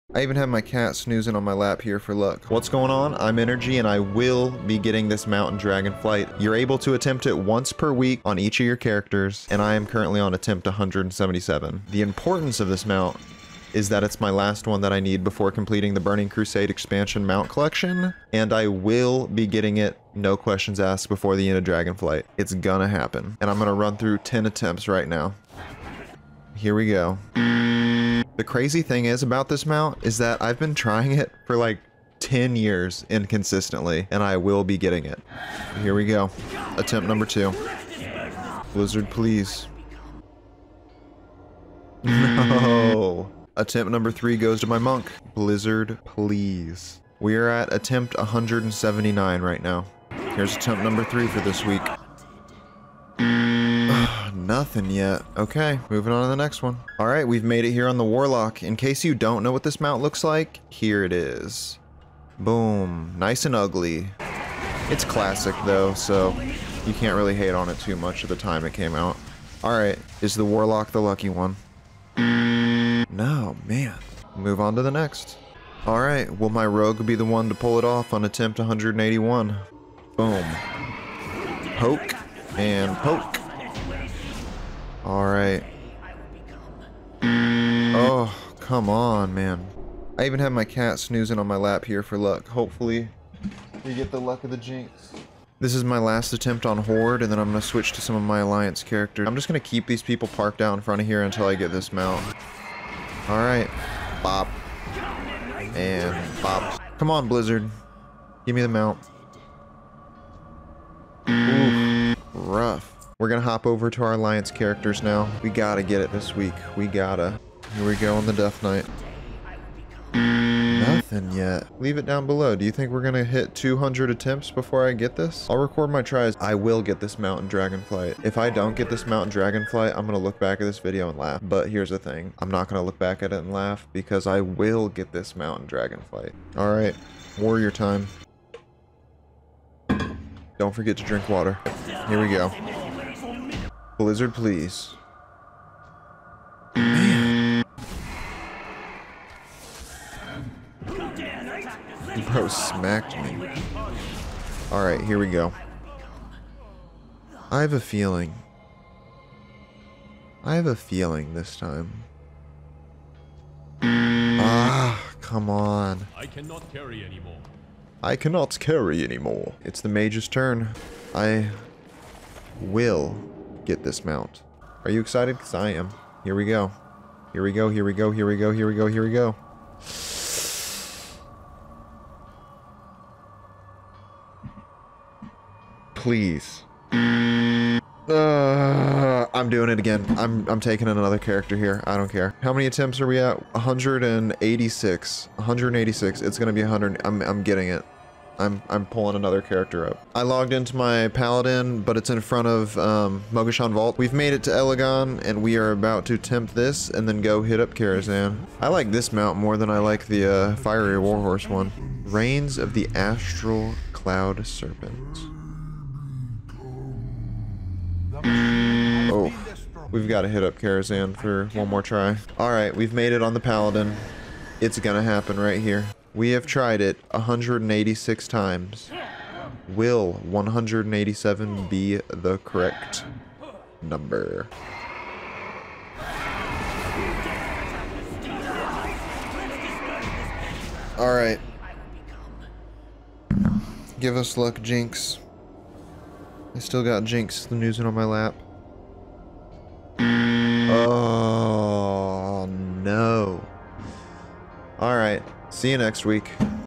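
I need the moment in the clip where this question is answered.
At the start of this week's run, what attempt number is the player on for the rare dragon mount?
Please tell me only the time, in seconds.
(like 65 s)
10 s.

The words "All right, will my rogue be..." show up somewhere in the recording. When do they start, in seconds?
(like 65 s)
75 s.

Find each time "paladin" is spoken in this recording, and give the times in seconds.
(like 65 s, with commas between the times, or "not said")
201 s, 223 s.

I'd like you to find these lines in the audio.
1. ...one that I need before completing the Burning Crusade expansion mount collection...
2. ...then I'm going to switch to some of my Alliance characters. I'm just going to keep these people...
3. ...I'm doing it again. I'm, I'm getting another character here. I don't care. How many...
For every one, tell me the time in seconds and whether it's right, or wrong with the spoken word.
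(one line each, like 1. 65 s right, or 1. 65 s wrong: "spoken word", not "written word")
1. 14 s right
2. 97 s right
3. 189 s wrong: "taking", not "getting".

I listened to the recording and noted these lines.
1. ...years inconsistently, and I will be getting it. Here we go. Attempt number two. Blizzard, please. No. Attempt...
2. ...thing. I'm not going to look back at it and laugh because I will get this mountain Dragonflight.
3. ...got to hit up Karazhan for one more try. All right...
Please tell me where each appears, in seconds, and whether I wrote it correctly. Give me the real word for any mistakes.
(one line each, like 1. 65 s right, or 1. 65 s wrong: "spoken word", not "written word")
1. 32 s right
2. 131 s right
3. 220 s right.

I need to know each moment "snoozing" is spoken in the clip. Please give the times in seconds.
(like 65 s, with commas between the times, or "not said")
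0 s, 90 s.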